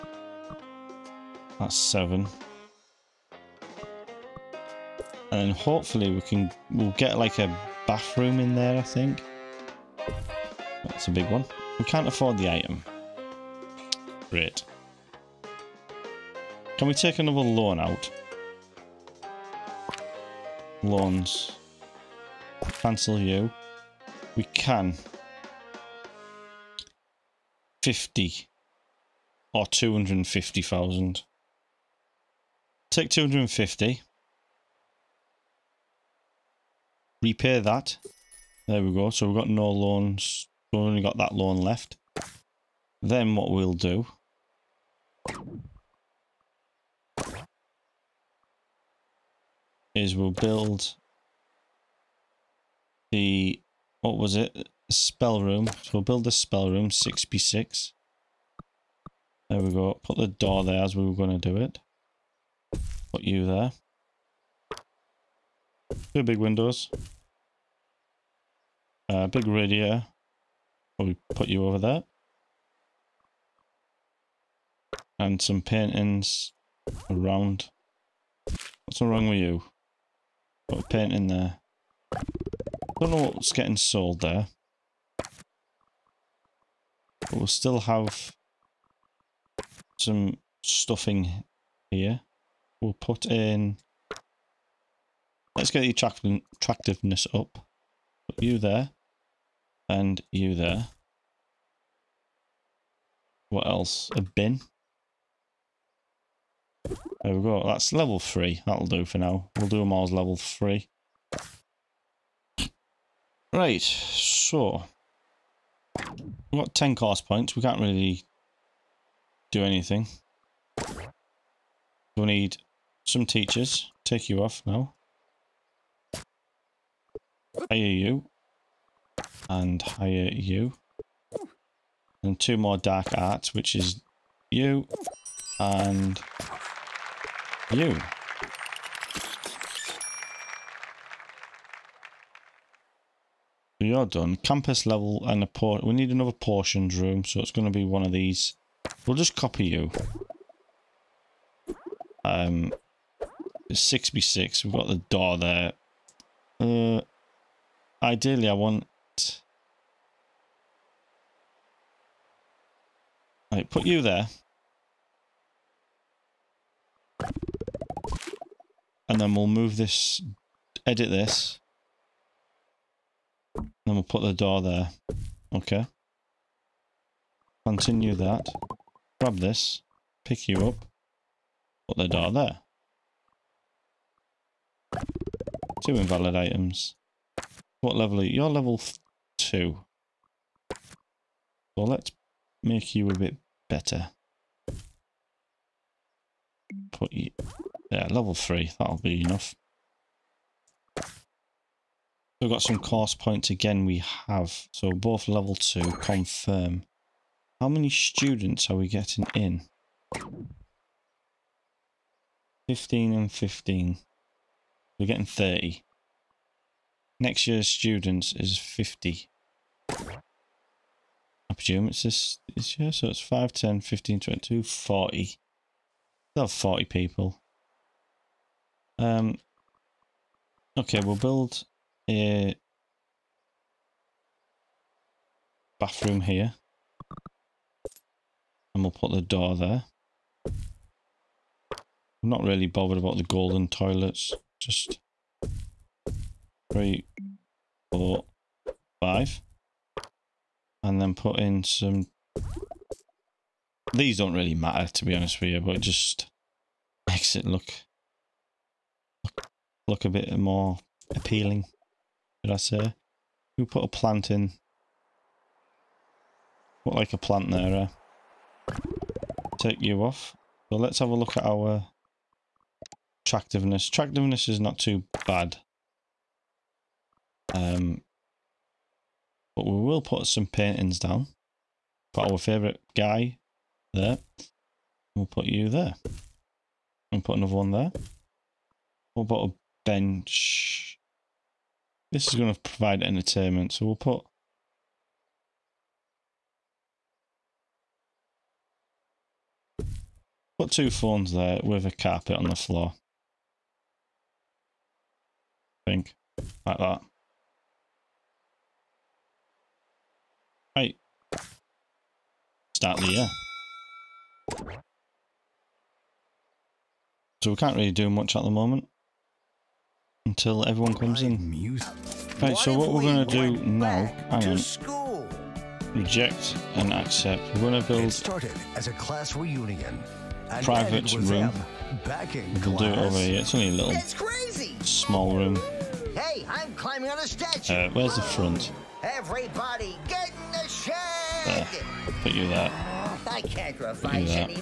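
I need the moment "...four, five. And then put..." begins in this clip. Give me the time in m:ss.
4:07.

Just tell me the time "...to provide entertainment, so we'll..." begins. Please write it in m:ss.
4:52.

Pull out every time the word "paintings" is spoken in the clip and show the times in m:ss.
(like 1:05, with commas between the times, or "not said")
1:15, 1:20, 4:40.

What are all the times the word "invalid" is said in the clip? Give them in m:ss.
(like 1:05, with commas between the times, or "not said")
3:05.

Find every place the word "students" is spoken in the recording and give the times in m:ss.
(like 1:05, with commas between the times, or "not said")
3:27, 3:37.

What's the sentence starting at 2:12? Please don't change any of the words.
And two more dark arts, which is you and you.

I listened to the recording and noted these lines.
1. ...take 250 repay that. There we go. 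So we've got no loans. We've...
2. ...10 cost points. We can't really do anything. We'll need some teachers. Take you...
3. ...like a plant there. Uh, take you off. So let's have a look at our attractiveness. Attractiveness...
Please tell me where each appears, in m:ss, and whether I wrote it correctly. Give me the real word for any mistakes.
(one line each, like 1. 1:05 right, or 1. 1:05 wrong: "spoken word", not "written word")
1. 0:32 right
2. 1:56 right
3. 4:26 right.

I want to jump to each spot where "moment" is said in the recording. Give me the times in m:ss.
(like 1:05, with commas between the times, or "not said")
5:18.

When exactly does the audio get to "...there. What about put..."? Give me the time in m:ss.
4:47.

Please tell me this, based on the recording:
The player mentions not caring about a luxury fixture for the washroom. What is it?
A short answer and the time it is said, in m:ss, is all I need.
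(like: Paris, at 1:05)
golden toilets, at 4:03.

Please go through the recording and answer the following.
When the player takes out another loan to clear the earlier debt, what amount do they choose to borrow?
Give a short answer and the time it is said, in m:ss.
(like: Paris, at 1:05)
250,000, at 0:29.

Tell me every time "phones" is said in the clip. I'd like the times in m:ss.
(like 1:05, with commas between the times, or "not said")
5:00.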